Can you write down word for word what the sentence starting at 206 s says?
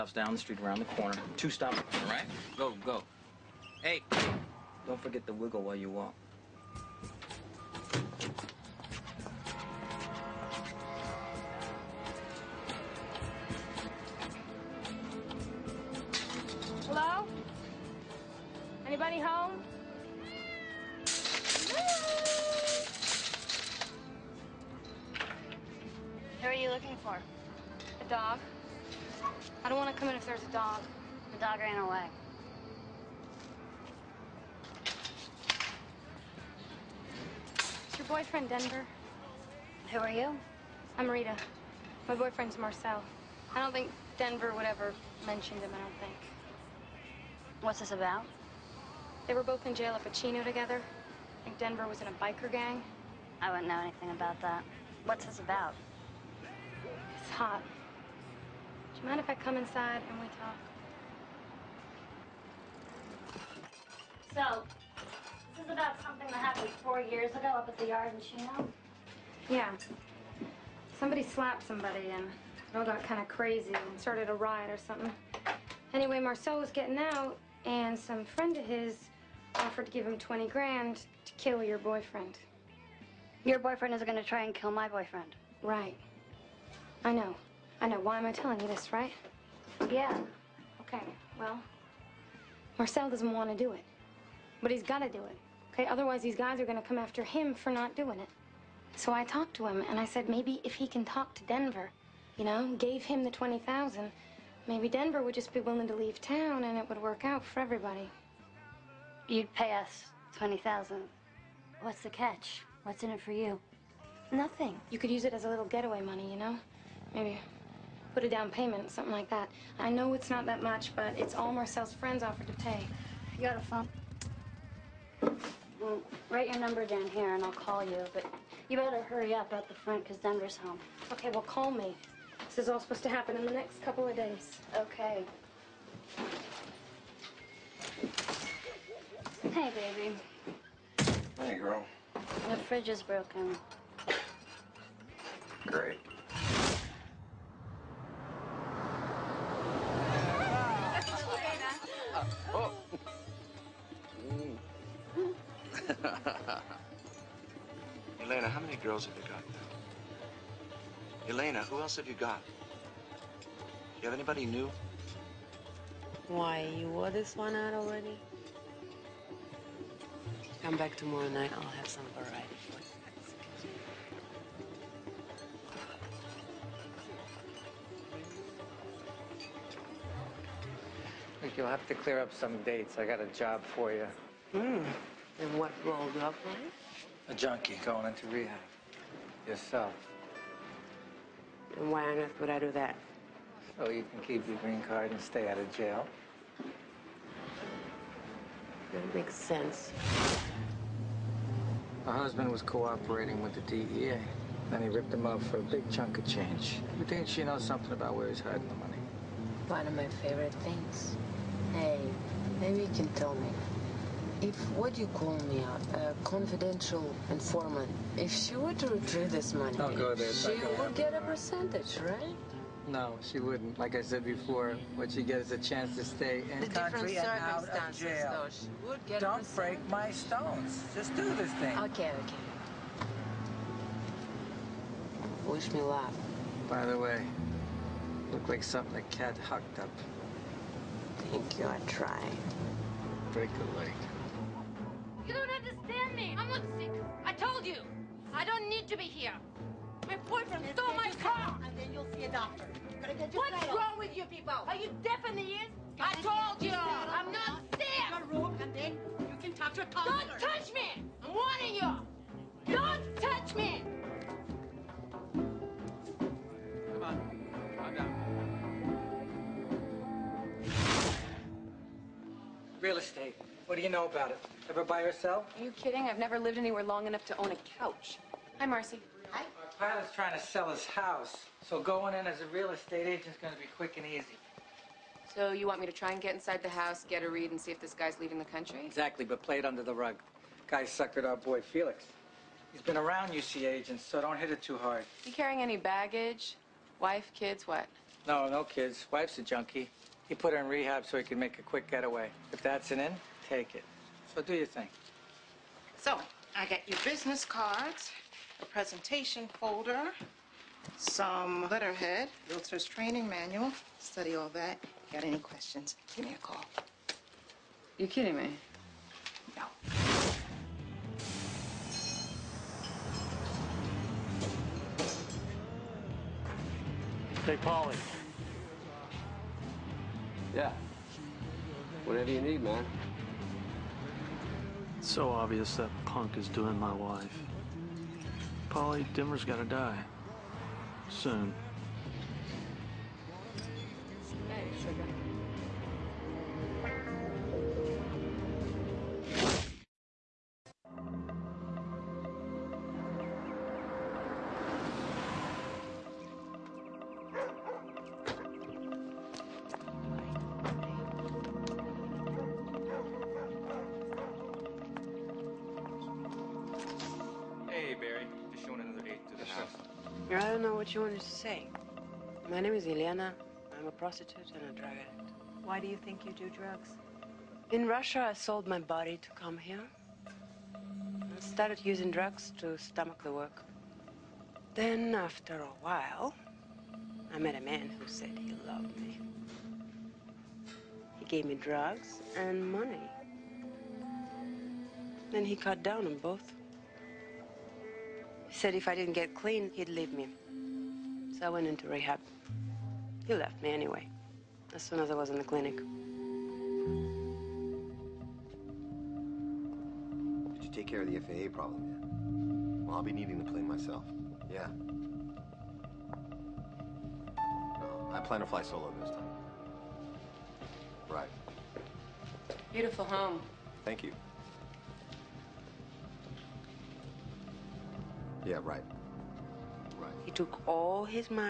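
You think she knows something about where he's hiding the money?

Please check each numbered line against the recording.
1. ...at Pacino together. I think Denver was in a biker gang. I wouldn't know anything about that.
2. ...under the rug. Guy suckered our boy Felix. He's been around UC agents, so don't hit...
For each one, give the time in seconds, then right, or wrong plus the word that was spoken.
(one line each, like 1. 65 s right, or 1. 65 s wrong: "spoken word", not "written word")
1. 49 s right
2. 289 s right.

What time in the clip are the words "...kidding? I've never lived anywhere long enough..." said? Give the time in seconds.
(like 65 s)
275 s.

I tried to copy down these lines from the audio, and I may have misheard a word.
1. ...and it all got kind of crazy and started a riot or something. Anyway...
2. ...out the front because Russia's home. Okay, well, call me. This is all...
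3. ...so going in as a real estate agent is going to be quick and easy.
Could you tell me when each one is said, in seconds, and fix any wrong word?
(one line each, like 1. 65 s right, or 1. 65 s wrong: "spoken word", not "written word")
1. 72 s right
2. 129 s wrong: "Denver", not "Russia"
3. 281 s right.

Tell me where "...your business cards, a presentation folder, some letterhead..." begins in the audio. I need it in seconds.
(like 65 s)
306 s.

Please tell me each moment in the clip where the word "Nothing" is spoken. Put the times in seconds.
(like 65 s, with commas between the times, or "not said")
114 s.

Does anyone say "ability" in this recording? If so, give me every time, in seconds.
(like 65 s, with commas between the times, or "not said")
not said.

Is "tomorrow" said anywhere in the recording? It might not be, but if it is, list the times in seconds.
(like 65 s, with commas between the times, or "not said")
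170 s.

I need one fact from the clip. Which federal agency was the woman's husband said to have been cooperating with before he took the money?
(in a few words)
DEA.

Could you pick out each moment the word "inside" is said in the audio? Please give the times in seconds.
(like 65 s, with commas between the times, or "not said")
59 s, 286 s.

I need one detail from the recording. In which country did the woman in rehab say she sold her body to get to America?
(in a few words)
Russia.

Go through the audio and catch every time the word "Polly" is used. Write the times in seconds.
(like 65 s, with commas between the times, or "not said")
327 s, 338 s.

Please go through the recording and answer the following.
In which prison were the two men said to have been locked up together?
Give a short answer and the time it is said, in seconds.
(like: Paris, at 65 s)
Chino, at 68 s.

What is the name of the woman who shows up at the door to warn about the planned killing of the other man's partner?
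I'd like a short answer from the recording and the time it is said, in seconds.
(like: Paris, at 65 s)
Rita, at 41 s.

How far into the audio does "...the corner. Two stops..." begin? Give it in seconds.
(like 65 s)
0 s.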